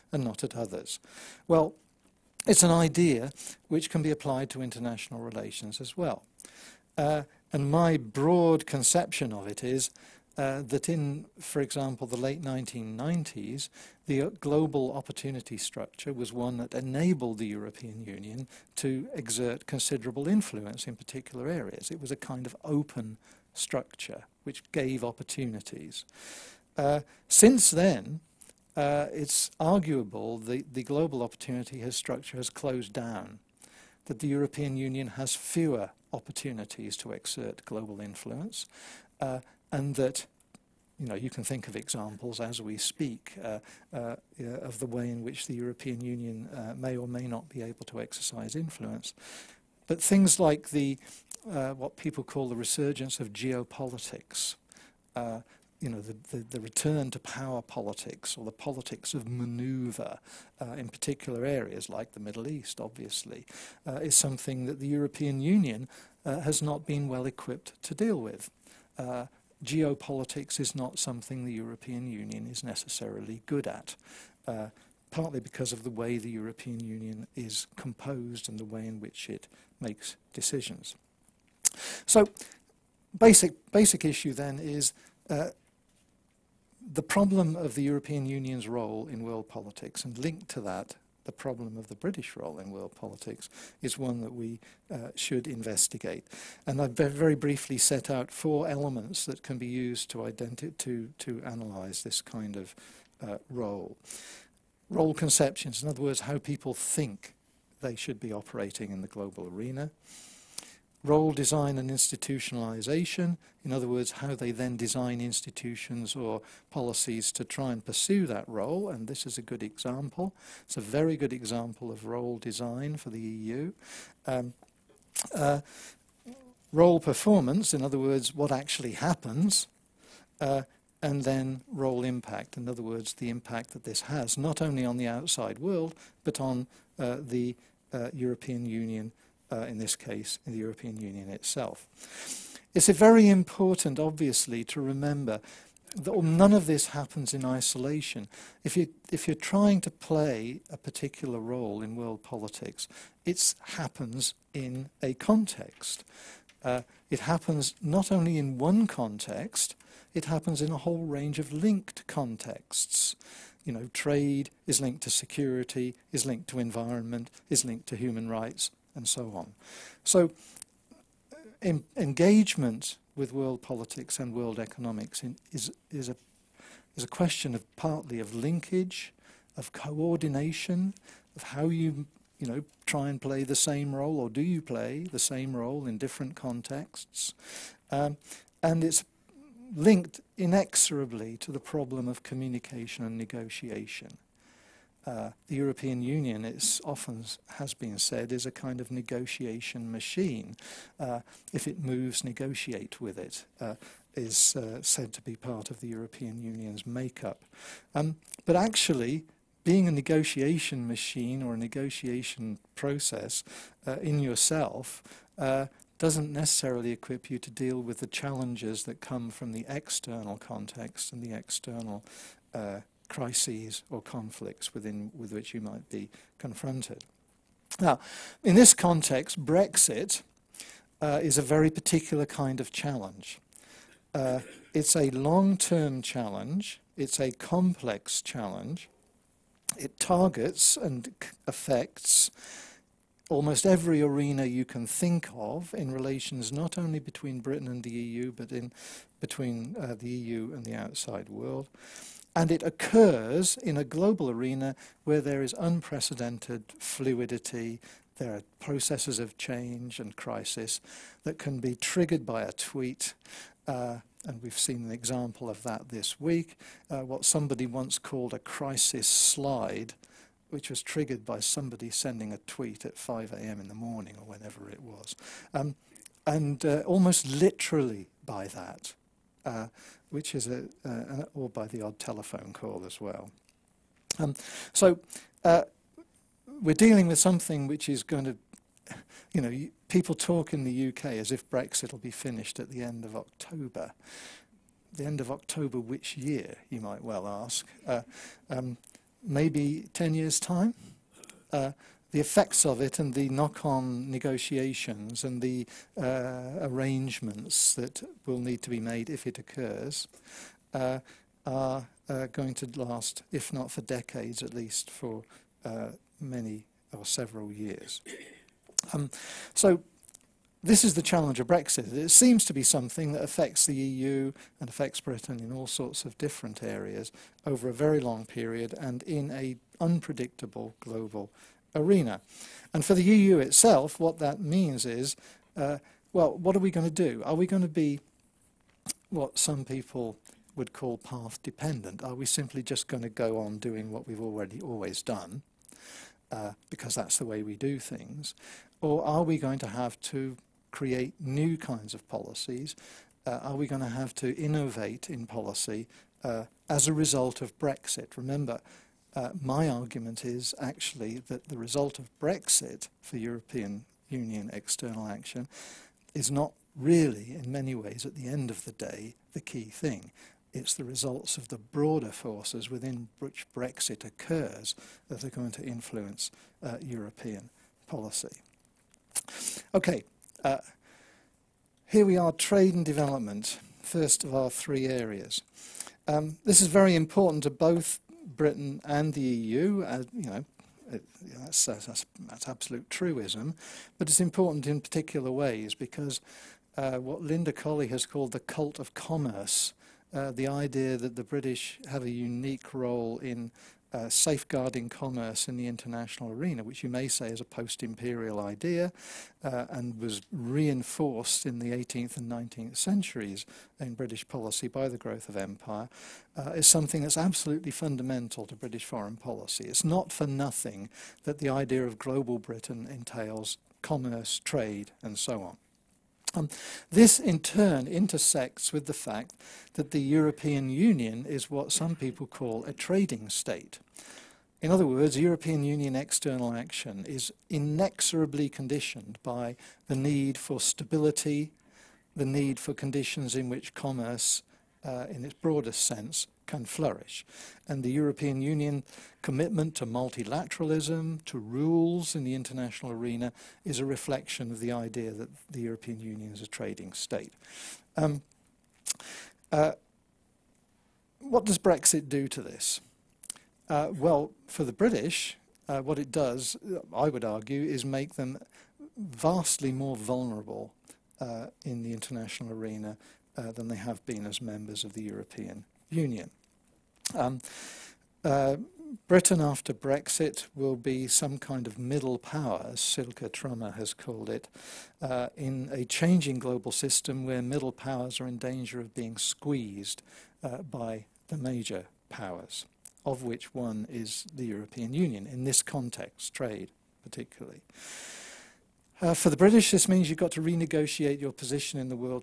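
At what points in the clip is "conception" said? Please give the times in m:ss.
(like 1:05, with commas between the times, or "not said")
0:08, 1:45.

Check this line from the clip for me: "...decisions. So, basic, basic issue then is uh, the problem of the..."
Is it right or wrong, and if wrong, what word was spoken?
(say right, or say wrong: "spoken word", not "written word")
right.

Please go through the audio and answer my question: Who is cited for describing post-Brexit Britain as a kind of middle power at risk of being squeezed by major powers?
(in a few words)
Silke Trommer.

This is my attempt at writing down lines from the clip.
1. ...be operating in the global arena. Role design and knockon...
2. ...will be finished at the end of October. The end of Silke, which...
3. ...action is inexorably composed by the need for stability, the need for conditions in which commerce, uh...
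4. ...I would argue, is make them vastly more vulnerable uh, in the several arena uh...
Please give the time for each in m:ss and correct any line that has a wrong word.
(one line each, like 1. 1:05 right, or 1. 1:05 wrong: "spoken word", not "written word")
1. 1:48 wrong: "institutionalization", not "knockon"
2. 4:51 wrong: "October", not "Silke"
3. 7:16 wrong: "conditioned", not "composed"
4. 7:46 wrong: "international", not "several".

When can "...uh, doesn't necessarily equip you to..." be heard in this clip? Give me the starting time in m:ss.
3:35.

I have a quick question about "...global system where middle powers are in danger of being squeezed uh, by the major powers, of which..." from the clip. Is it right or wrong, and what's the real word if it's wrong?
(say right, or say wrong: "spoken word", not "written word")
right.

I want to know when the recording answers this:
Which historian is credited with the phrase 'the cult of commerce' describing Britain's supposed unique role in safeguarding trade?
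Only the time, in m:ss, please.
6:37.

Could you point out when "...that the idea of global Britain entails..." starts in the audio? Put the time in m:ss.
7:01.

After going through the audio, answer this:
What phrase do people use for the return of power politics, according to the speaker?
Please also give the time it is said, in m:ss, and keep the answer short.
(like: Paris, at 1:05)
resurgence of geopolitics, at 0:52.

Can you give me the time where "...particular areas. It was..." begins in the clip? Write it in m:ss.
0:20.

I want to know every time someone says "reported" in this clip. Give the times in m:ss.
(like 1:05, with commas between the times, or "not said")
not said.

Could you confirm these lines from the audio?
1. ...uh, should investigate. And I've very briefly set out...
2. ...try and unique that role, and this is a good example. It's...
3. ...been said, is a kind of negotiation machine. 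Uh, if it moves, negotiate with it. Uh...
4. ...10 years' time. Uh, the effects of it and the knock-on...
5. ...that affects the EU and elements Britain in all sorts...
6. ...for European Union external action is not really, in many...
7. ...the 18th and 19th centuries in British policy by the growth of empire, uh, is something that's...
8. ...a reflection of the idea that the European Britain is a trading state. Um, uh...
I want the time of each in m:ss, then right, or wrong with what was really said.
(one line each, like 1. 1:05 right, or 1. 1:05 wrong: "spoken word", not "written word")
1. 1:34 right
2. 1:57 wrong: "pursue", not "unique"
3. 3:17 right
4. 4:59 right
5. 5:23 wrong: "affects", not "elements"
6. 6:03 right
7. 6:51 right
8. 7:33 wrong: "Union", not "Britain".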